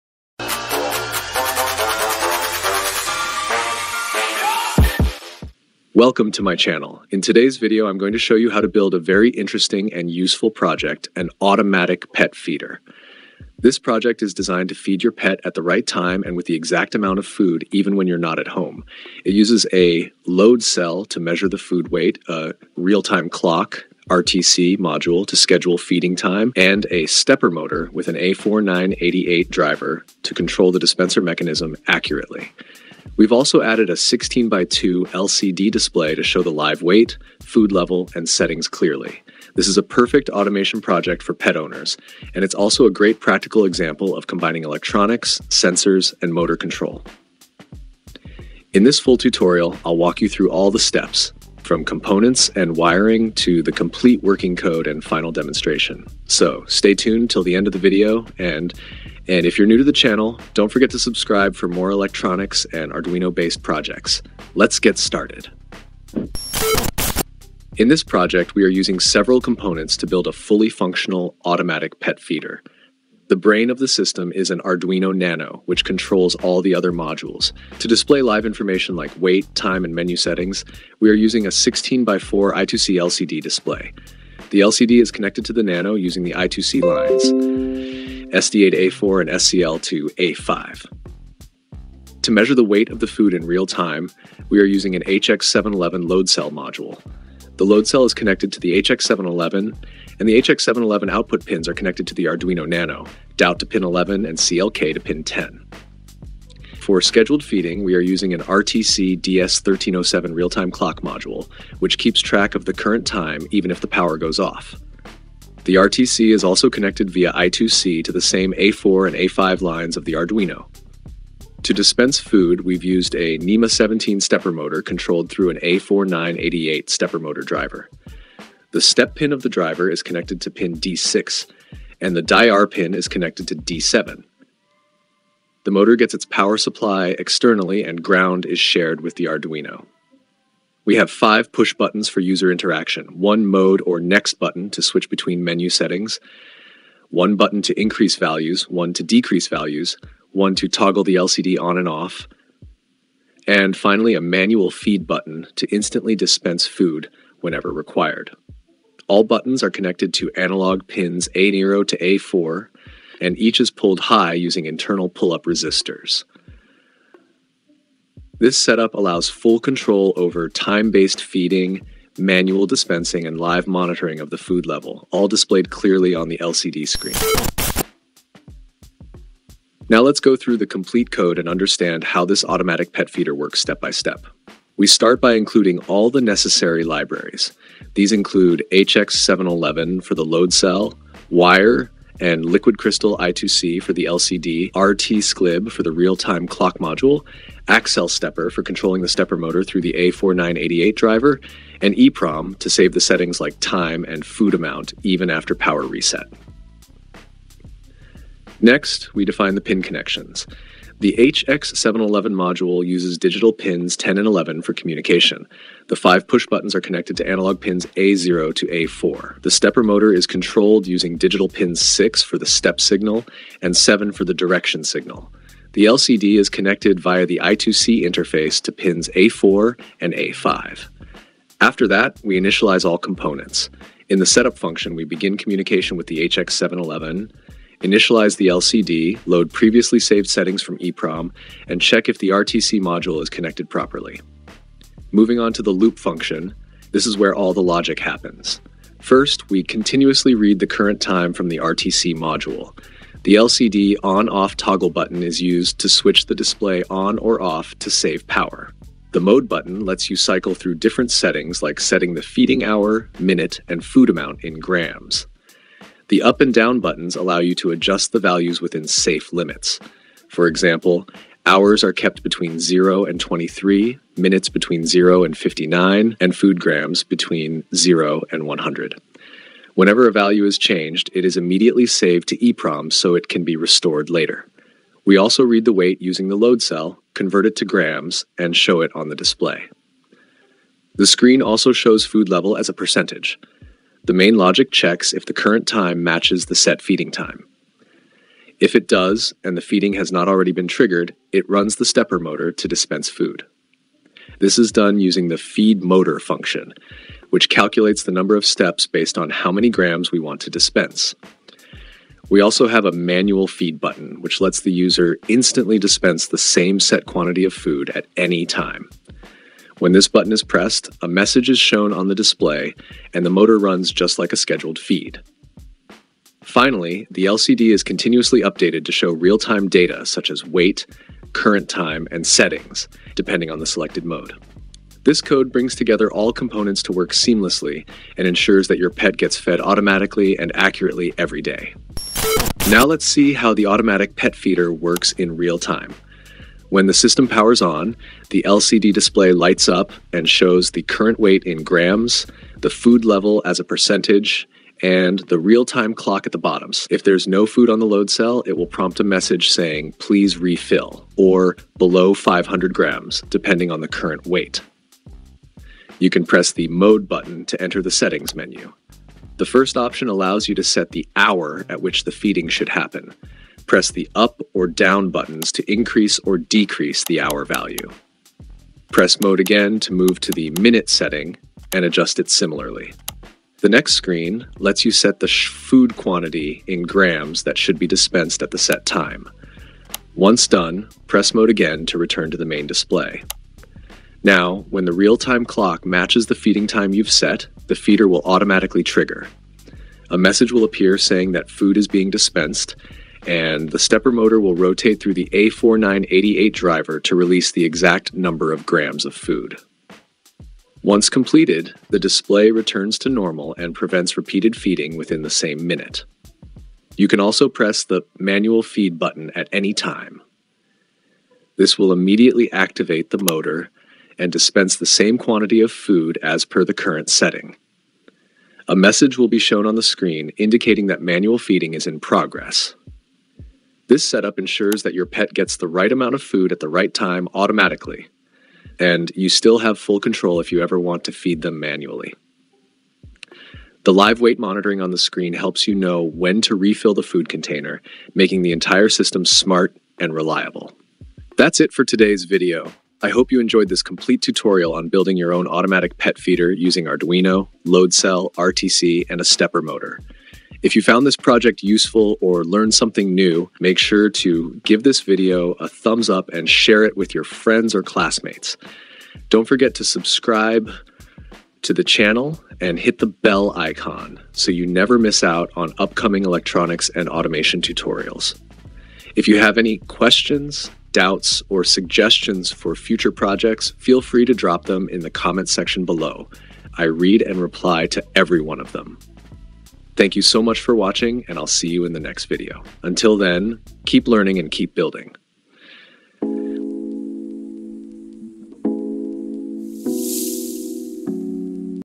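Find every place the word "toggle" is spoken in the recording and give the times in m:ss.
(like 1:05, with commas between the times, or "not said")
2:30, 4:14.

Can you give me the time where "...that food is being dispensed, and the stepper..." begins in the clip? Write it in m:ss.
6:41.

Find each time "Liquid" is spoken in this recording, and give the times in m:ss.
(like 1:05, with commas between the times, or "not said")
3:12.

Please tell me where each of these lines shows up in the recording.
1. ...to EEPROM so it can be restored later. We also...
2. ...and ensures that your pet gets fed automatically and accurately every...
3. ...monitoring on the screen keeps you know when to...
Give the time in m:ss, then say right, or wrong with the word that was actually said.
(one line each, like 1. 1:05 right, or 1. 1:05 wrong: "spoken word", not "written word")
1. 4:42 right
2. 5:38 right
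3. 7:24 wrong: "helps", not "keeps".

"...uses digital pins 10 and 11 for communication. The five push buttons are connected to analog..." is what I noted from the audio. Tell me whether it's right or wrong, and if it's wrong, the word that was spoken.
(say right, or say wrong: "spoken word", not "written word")
right.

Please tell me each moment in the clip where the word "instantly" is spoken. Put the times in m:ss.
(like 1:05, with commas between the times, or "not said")
2:35, 5:15.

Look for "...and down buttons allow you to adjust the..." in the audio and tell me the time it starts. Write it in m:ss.
4:26.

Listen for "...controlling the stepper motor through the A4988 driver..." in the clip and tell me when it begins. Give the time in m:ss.
3:18.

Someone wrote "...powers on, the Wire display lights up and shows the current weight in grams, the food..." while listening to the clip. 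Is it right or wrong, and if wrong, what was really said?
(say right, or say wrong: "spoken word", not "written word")
wrong: "LCD", not "Wire".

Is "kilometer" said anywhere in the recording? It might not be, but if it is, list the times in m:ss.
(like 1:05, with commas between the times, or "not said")
not said.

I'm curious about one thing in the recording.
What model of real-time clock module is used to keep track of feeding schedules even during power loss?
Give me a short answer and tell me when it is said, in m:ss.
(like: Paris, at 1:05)
DS1307, at 1:49.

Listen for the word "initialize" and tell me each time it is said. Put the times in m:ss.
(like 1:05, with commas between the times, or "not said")
3:52, 3:57.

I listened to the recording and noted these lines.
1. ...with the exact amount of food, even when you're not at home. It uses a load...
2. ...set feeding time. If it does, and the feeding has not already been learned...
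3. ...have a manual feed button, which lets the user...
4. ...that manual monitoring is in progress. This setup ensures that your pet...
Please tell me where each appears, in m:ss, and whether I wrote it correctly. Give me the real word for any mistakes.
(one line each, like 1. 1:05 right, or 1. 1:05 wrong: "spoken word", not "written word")
1. 0:16 right
2. 4:56 wrong: "triggered", not "learned"
3. 5:12 right
4. 7:10 wrong: "feeding", not "monitoring".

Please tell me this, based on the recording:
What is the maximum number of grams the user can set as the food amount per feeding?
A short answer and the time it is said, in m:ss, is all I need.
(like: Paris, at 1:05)
100, at 4:38.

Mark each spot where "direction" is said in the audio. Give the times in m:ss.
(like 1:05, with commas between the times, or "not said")
3:44.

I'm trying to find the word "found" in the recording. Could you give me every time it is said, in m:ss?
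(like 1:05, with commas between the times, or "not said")
7:40.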